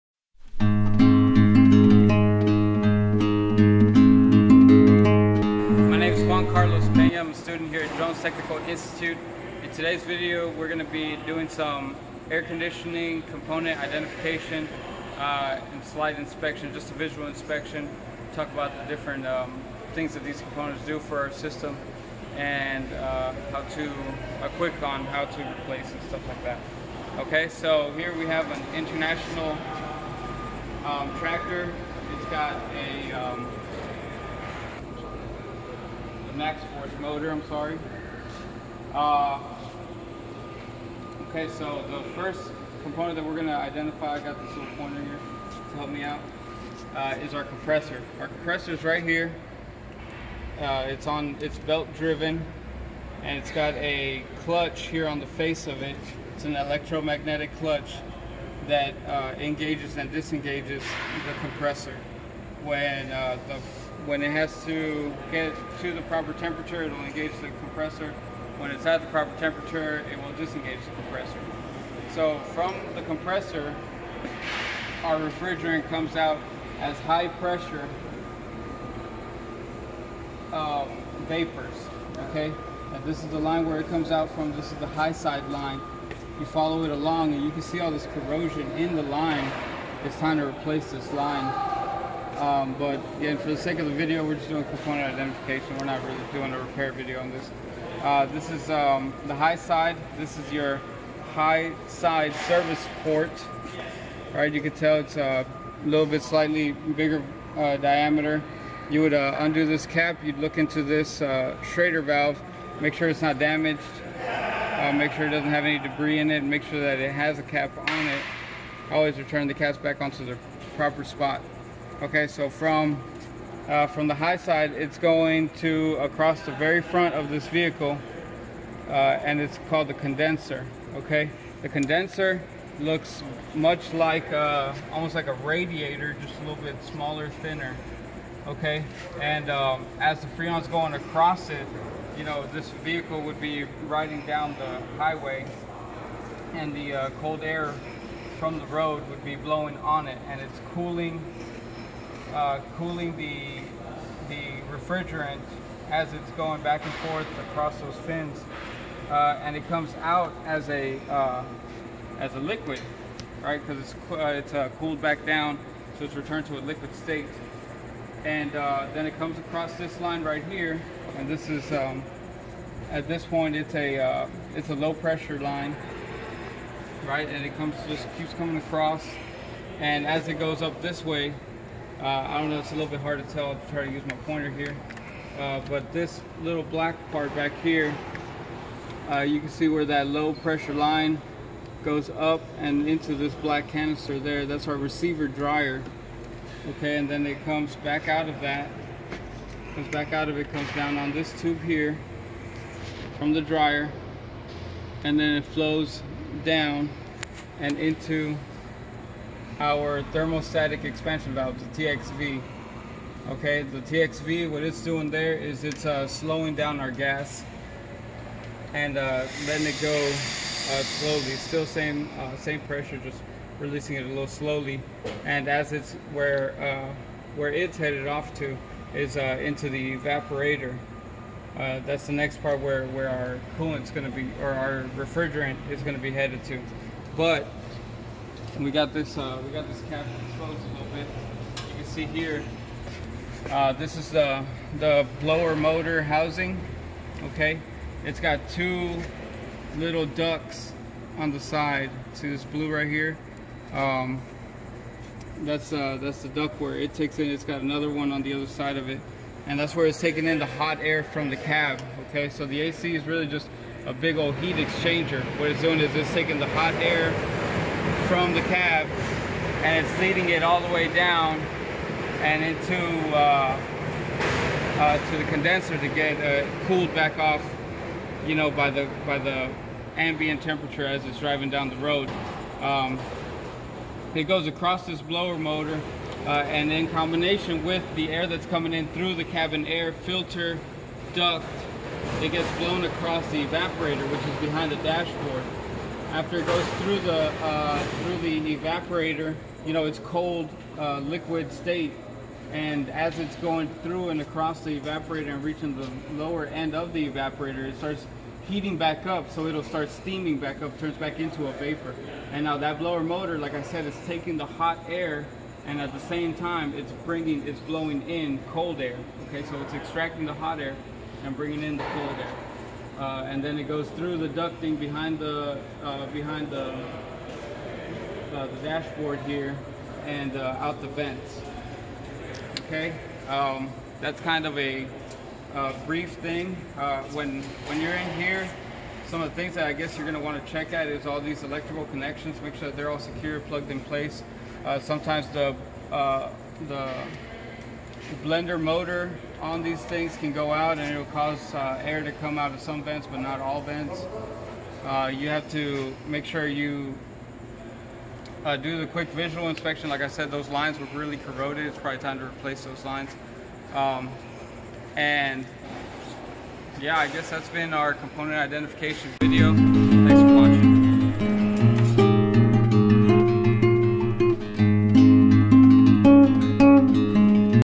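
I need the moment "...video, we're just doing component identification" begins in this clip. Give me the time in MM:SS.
01:33.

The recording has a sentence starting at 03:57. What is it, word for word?
But we got this uh, we got this cap exposed a little bit.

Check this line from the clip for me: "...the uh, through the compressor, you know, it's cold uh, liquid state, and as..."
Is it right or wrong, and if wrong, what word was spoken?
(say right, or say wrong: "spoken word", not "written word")
wrong: "evaporator", not "compressor".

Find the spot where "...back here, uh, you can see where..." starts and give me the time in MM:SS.
03:07.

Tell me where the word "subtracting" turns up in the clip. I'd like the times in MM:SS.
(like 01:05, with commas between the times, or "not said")
not said.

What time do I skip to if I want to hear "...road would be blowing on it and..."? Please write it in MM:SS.
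02:28.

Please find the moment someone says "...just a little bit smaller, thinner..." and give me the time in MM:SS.
02:16.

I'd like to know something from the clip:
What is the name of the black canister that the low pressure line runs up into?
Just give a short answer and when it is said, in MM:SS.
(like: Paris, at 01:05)
Receiver dryer, at 03:14.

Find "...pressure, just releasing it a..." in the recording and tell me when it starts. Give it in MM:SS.
03:42.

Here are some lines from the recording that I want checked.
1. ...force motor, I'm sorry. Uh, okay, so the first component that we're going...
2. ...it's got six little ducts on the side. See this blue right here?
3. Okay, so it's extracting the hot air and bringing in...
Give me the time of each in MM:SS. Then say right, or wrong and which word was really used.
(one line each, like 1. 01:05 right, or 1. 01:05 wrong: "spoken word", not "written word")
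1. 00:36 right
2. 04:08 wrong: "two", not "six"
3. 05:19 right.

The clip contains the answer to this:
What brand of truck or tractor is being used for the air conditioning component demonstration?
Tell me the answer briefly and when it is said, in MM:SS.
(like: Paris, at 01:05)
International, at 00:28.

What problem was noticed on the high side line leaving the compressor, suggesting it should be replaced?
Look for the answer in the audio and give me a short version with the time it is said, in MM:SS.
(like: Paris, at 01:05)
Corrosion, at 01:28.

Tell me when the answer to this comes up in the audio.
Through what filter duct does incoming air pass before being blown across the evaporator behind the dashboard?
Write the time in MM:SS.
04:49.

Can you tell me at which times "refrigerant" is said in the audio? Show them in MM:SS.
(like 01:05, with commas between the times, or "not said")
01:15, 02:34, 03:54.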